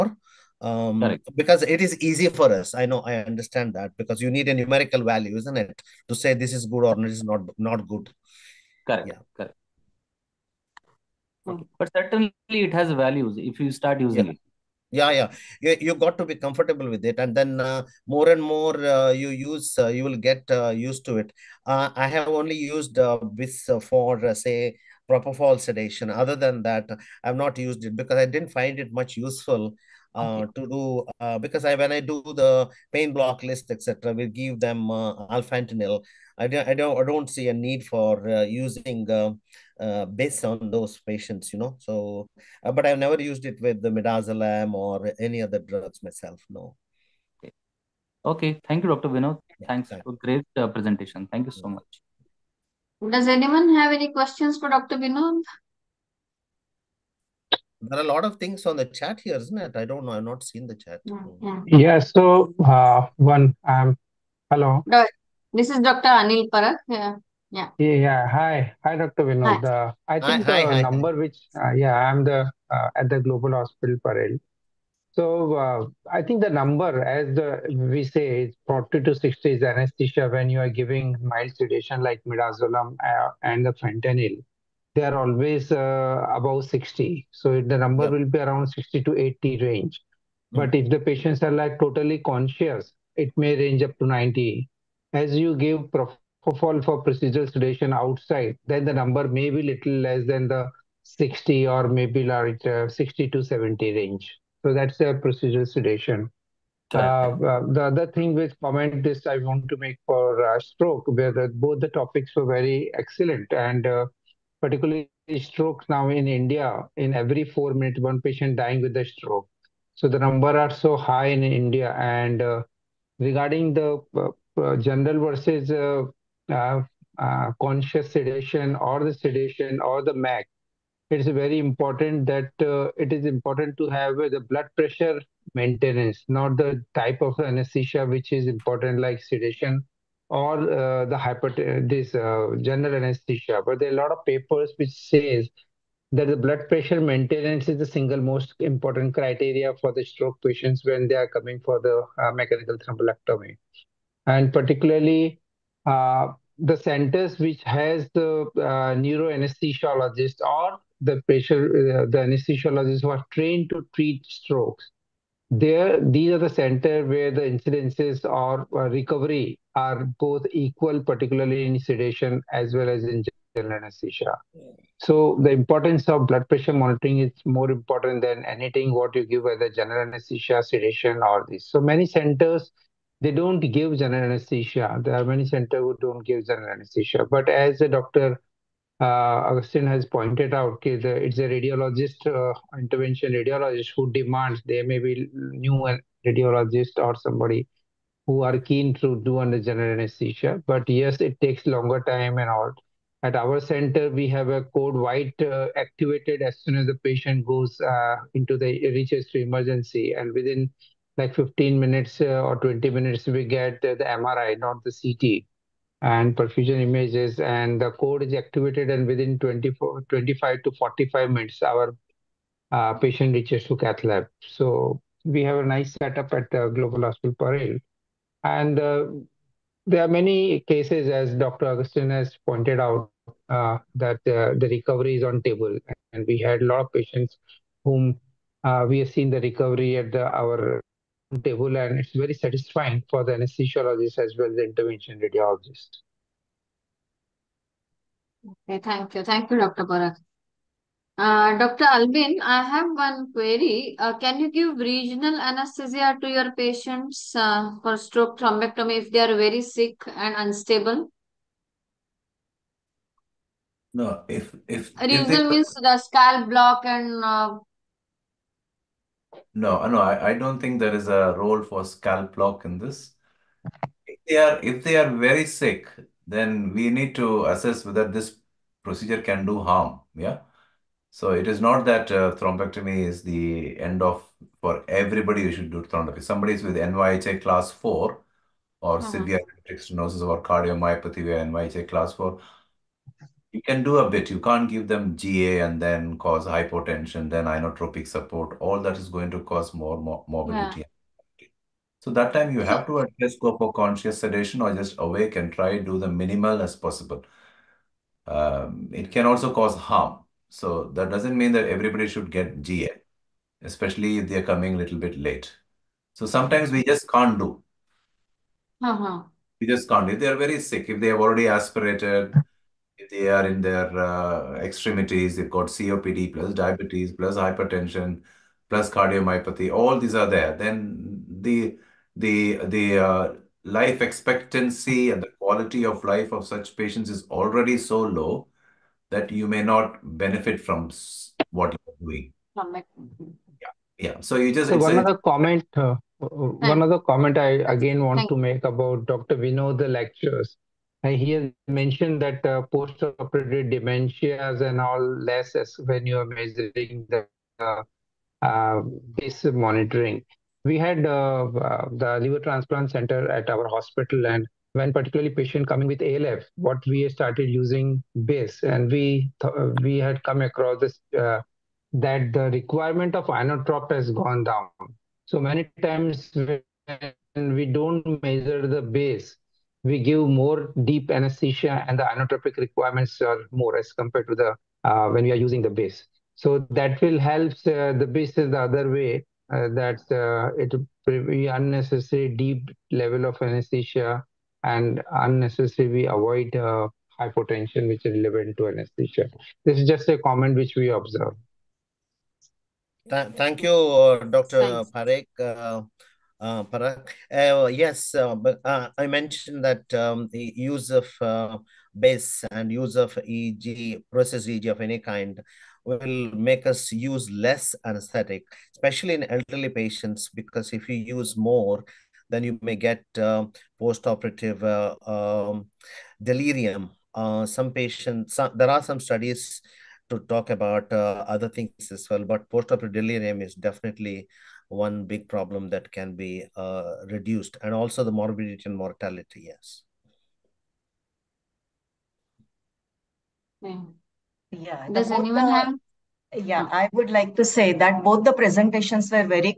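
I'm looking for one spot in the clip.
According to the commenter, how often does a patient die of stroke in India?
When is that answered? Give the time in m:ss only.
1:57.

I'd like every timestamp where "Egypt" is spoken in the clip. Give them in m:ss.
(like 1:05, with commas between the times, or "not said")
not said.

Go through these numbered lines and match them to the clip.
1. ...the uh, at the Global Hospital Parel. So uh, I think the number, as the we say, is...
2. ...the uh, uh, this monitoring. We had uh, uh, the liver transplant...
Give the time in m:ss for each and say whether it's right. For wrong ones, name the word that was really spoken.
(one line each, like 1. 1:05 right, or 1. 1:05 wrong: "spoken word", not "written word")
1. 1:12 right
2. 5:57 right.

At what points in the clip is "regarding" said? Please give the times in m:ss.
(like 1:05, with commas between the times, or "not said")
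2:03.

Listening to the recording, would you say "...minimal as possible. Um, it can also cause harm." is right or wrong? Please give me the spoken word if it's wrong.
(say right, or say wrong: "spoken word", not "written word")
right.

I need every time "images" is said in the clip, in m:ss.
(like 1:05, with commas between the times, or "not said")
3:36.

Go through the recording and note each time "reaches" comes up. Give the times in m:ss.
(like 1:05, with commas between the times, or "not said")
3:28, 3:43.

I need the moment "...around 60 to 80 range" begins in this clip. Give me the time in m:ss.
1:28.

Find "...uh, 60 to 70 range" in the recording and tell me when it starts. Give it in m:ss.
1:42.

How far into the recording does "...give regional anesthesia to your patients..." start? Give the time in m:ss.
4:14.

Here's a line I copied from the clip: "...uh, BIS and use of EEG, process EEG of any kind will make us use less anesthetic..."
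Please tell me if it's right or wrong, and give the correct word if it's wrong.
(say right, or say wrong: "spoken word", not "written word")
right.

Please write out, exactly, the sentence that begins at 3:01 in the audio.
So many centers they don't give general anesthesia.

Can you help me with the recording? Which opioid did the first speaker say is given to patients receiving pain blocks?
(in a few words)
Alfentanil.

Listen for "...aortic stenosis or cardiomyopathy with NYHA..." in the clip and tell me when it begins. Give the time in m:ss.
4:49.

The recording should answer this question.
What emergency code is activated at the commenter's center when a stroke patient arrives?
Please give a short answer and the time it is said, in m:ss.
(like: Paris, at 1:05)
Code white, at 3:24.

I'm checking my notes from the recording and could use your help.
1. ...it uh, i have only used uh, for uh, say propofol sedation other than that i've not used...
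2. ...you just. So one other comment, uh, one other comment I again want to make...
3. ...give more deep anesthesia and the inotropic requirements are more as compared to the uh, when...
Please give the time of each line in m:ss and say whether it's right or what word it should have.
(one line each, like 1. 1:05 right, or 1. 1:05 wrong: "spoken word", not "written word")
1. 0:21 right
2. 5:44 right
3. 6:20 right.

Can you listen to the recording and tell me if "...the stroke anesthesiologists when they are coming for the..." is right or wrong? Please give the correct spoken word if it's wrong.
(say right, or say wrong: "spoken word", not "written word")
wrong: "patients", not "anesthesiologists".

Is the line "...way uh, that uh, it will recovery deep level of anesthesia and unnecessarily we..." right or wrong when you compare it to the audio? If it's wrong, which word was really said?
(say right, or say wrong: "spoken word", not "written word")
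wrong: "unnecessary", not "recovery".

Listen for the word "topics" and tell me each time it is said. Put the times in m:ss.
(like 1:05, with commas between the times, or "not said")
1:51.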